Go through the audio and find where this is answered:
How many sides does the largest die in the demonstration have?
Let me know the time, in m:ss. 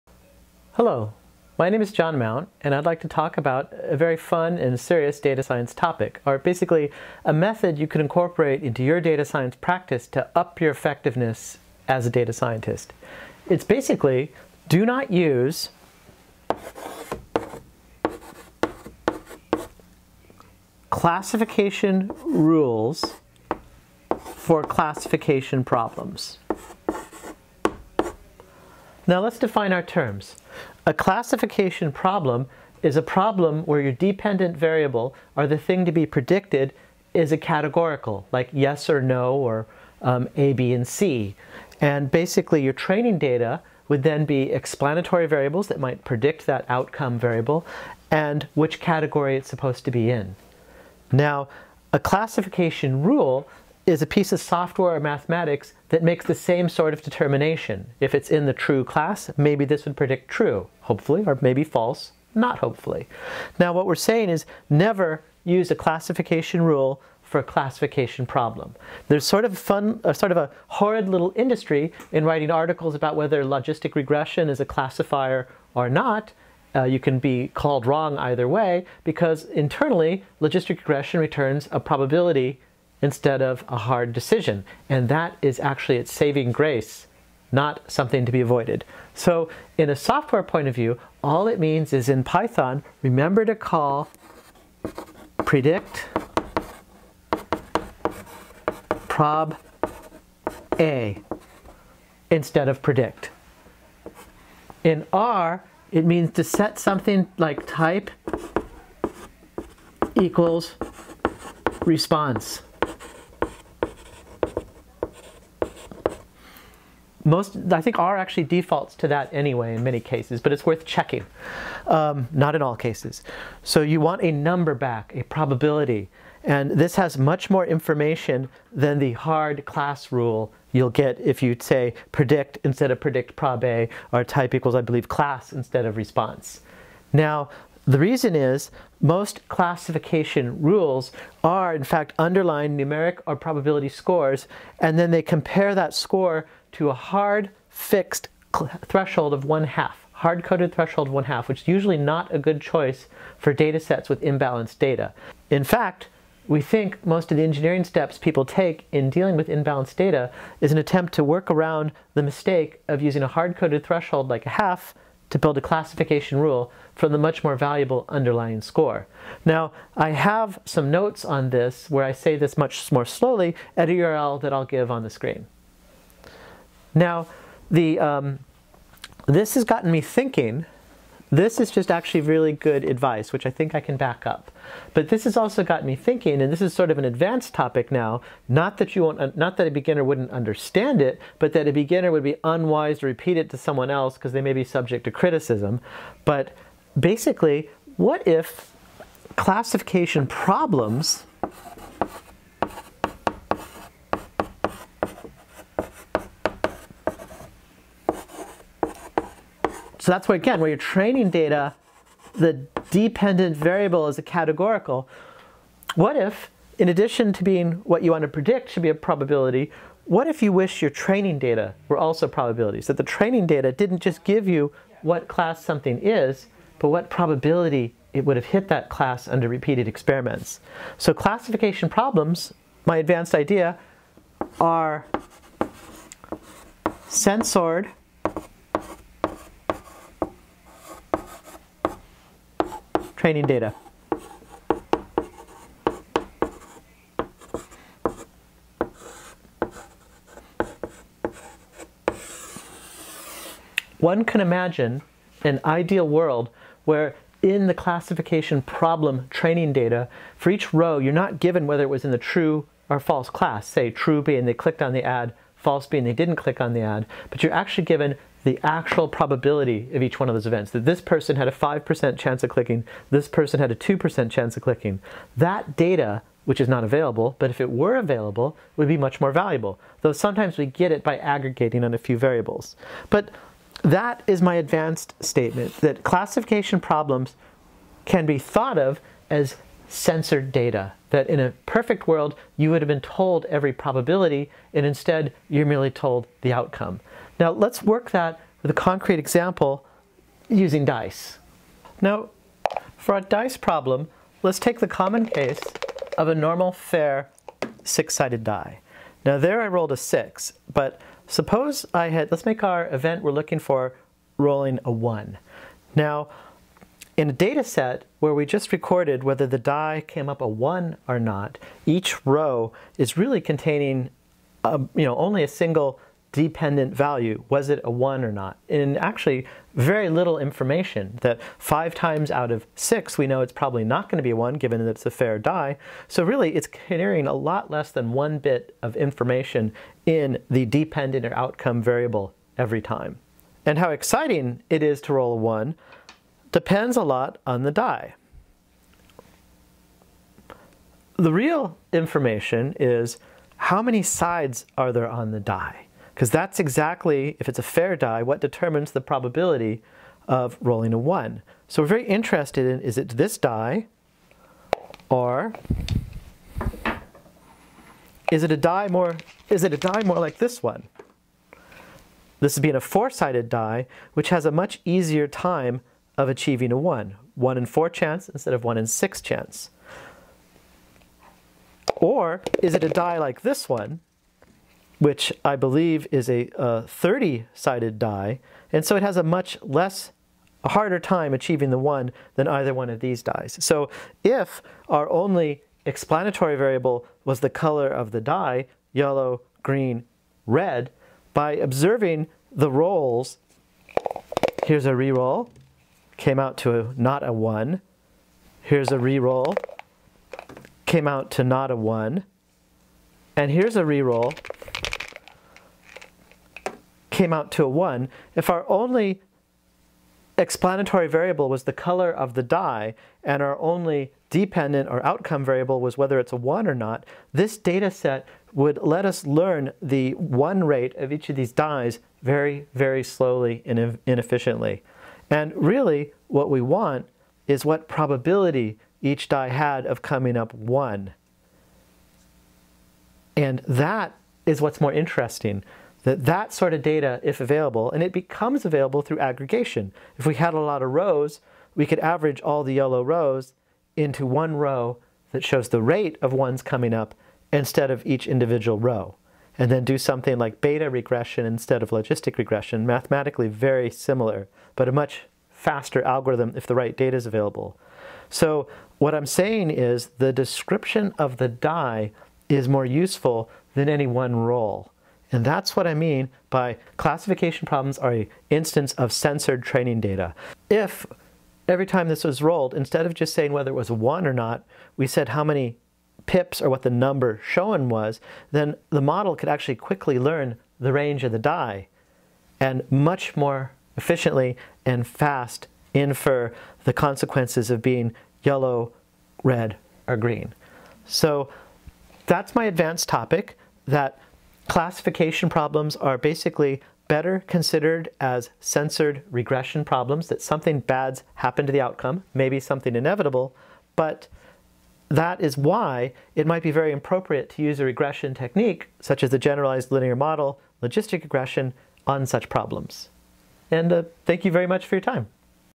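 6:26.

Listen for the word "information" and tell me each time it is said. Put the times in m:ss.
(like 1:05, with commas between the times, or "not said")
2:07, 5:30, 5:38, 5:51.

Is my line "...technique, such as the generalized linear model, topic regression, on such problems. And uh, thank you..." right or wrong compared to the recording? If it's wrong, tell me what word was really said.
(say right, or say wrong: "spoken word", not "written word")
wrong: "logistic", not "topic".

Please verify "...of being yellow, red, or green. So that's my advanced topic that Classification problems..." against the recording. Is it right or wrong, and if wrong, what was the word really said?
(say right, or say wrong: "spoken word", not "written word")
right.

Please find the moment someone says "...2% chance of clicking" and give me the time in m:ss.
4:33.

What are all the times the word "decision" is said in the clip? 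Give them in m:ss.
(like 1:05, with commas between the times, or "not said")
1:24.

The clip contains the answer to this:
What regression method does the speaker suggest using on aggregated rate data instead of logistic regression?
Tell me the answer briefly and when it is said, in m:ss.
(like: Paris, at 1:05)
beta regression, at 7:40.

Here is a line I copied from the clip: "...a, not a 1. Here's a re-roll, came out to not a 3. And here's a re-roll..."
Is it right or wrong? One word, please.
wrong.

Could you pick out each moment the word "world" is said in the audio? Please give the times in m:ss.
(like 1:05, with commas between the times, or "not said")
4:16, 4:52.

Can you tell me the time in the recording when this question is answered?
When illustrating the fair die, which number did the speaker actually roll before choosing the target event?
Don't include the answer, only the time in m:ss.
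5:09.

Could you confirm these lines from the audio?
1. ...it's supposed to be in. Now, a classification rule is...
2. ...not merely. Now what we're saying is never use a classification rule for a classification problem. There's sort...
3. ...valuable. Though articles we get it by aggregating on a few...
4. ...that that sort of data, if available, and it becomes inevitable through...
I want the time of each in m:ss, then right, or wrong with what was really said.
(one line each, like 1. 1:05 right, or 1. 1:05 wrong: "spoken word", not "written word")
1. 0:49 right
2. 1:02 wrong: "hopefully", not "merely"
3. 4:39 wrong: "sometimes", not "articles"
4. 7:26 wrong: "available", not "inevitable".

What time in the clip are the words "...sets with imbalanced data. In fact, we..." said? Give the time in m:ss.
2:33.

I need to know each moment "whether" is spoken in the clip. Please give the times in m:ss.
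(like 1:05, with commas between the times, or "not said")
1:13, 4:21, 5:19, 7:05, 8:03.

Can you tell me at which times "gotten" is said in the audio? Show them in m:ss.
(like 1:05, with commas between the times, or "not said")
2:59.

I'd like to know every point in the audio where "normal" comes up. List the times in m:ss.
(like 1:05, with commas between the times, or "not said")
5:06.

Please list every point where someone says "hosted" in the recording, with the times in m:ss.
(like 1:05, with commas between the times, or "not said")
not said.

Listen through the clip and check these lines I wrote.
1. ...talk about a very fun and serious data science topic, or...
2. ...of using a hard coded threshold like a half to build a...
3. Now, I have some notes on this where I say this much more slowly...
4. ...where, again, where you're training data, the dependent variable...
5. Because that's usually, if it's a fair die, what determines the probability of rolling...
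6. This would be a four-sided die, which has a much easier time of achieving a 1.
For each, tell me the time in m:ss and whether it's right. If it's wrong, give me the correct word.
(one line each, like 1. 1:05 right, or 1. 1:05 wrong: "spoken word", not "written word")
1. 0:03 right
2. 2:42 right
3. 2:49 right
4. 3:30 right
5. 5:56 wrong: "exactly", not "usually"
6. 6:12 right.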